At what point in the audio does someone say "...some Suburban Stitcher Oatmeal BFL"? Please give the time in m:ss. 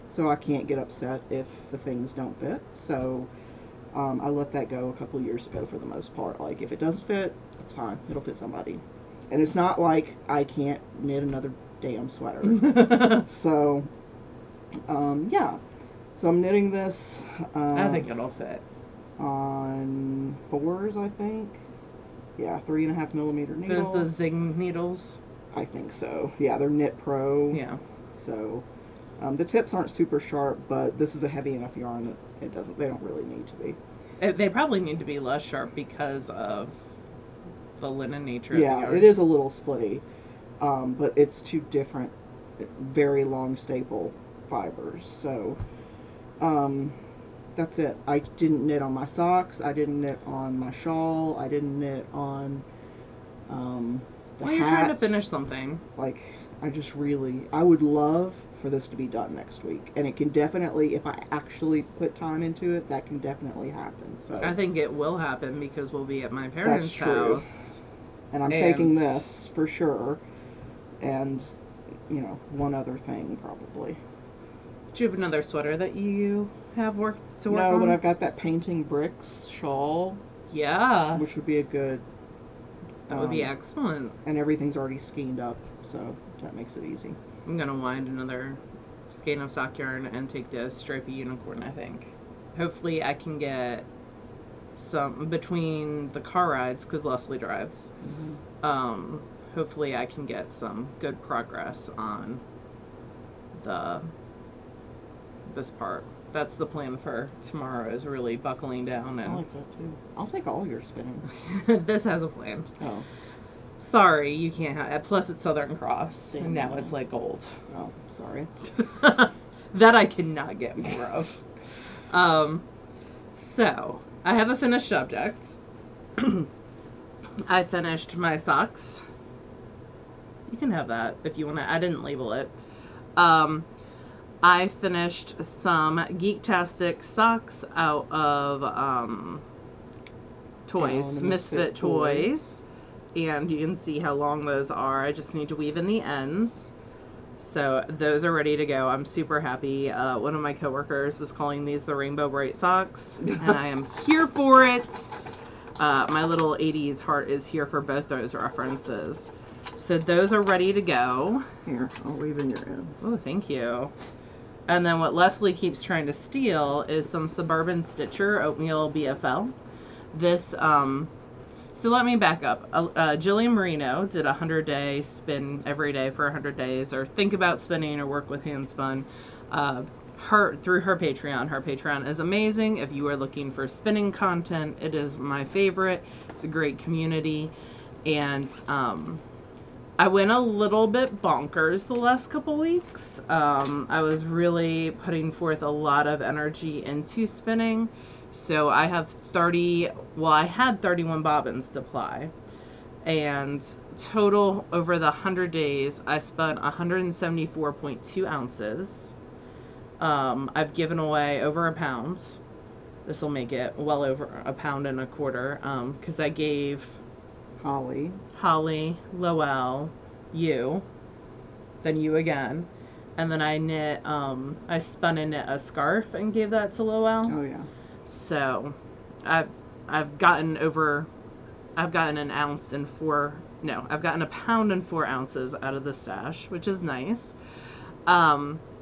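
2:47.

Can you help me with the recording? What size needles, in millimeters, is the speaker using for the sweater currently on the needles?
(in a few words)
3.5 millimeters.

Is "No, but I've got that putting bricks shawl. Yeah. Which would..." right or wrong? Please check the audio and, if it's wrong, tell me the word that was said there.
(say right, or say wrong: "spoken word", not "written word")
wrong: "painting", not "putting".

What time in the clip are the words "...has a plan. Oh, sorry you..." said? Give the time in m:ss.
1:52.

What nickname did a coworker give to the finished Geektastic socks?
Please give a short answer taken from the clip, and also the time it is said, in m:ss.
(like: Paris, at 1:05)
Rainbow Brite Socks, at 2:31.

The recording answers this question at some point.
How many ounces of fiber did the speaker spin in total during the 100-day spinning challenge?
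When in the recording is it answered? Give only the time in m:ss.
3:26.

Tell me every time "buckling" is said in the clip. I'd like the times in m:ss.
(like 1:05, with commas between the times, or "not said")
1:48.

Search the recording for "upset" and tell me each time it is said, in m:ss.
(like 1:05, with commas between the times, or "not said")
0:00.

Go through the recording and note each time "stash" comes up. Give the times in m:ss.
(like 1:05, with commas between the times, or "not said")
3:55.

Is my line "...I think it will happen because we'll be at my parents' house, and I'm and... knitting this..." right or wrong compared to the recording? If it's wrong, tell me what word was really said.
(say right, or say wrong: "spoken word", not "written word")
wrong: "taking", not "knitting".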